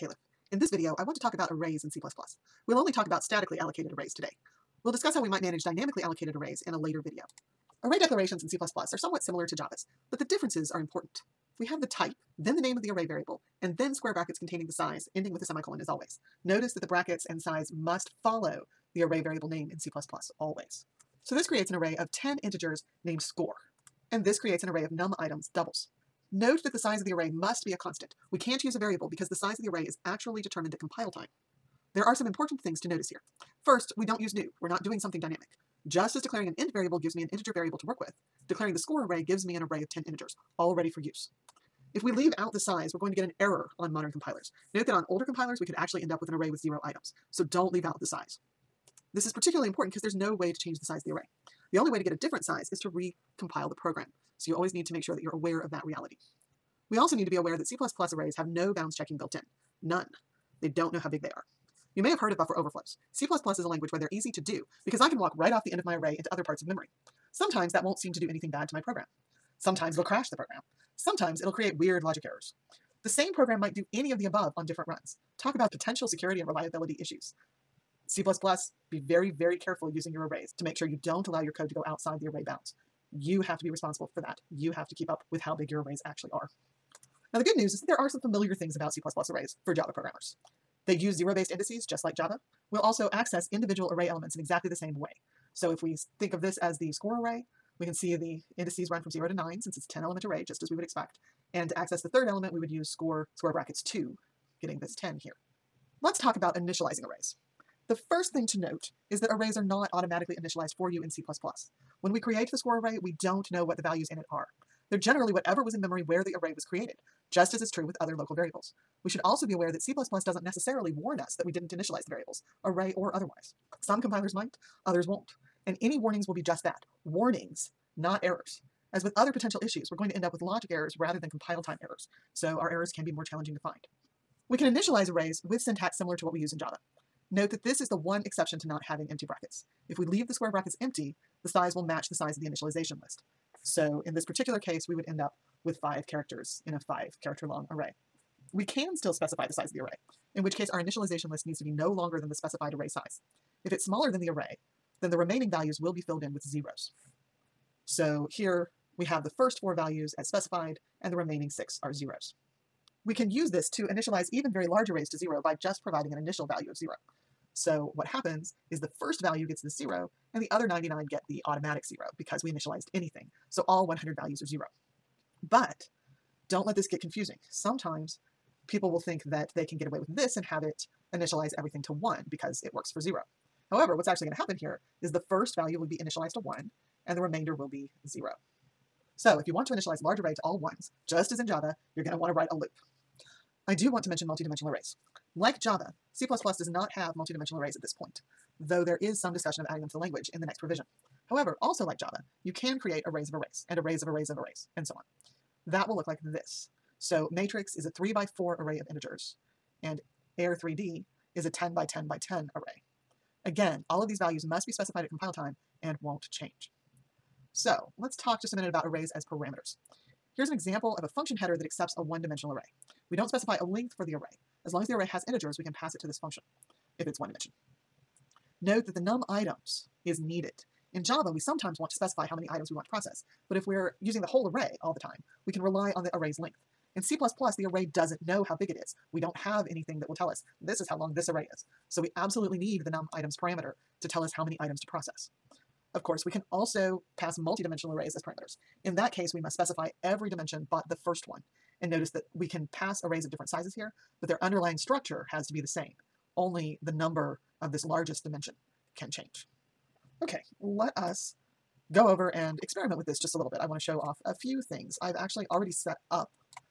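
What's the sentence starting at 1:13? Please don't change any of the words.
The same program might do any of the above on different runs.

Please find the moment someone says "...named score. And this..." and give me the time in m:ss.
0:23.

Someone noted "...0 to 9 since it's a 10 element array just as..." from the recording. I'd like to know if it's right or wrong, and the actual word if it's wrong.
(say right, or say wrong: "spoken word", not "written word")
right.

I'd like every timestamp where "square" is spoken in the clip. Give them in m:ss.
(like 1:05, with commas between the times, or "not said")
0:13, 1:43, 2:20.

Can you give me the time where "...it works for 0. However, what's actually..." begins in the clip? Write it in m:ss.
3:02.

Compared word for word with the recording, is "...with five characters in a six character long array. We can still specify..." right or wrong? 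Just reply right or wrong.
wrong.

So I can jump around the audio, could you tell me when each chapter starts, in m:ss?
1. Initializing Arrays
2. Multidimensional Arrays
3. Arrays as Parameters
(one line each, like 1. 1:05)
1. 1:45
2. 3:13
3. 3:37.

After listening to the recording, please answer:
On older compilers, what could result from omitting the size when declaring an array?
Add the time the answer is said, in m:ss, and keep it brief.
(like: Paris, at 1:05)
zero items, at 0:46.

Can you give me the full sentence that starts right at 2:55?
But don't let this get confusing.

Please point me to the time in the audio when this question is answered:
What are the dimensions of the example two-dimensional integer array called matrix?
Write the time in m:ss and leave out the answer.
3:27.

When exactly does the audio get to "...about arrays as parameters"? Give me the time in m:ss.
3:38.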